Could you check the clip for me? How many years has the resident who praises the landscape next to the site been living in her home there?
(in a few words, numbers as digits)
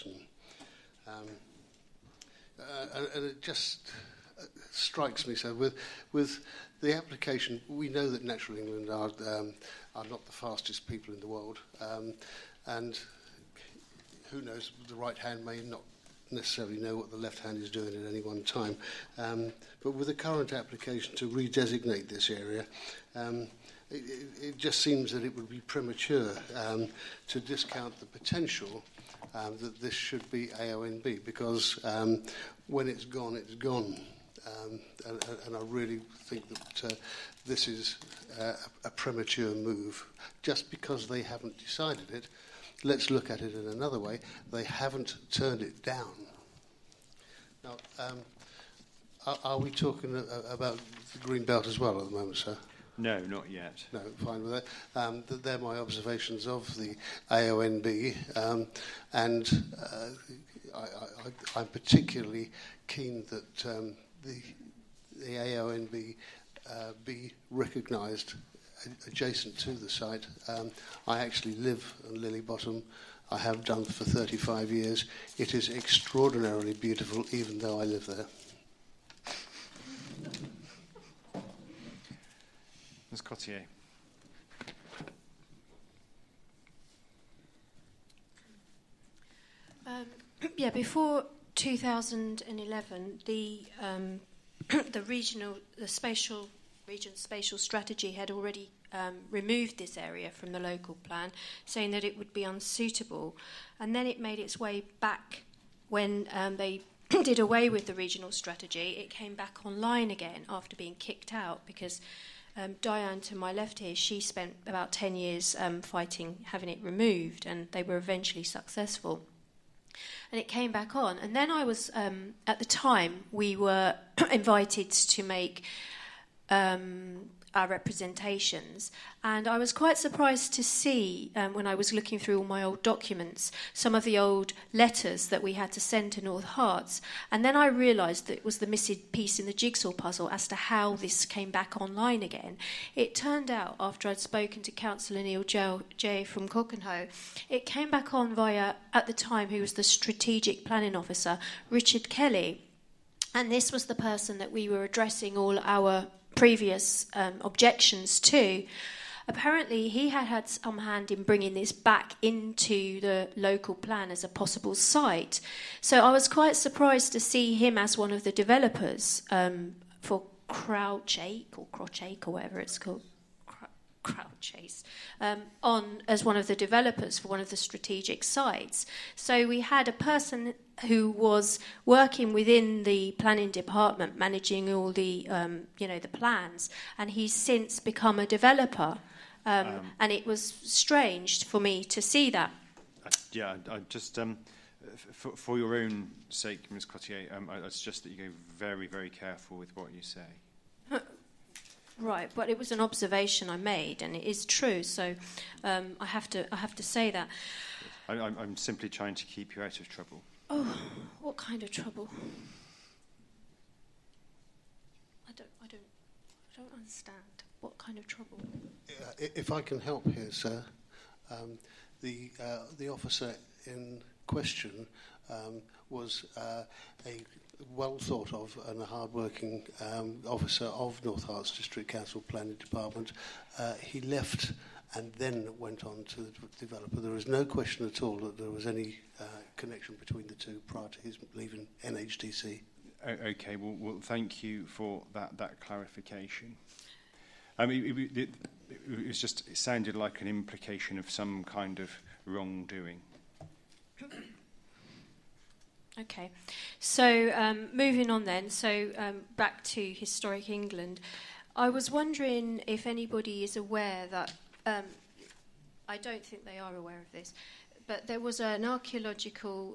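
35.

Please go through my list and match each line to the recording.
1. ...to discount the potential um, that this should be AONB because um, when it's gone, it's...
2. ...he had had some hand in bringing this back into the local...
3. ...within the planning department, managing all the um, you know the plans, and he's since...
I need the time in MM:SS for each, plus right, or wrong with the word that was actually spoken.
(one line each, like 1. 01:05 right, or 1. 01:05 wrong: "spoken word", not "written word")
1. 00:27 right
2. 02:39 right
3. 03:02 right.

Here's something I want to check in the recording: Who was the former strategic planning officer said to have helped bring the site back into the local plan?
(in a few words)
Richard Kelly.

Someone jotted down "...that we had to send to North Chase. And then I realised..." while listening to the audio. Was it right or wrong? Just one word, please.
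wrong.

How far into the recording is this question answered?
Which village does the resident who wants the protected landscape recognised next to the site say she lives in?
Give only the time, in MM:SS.
01:12.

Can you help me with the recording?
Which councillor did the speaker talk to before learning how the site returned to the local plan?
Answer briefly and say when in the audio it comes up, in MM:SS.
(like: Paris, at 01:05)
Neil Jay, at 02:25.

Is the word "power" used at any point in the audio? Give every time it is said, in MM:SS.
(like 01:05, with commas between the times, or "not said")
not said.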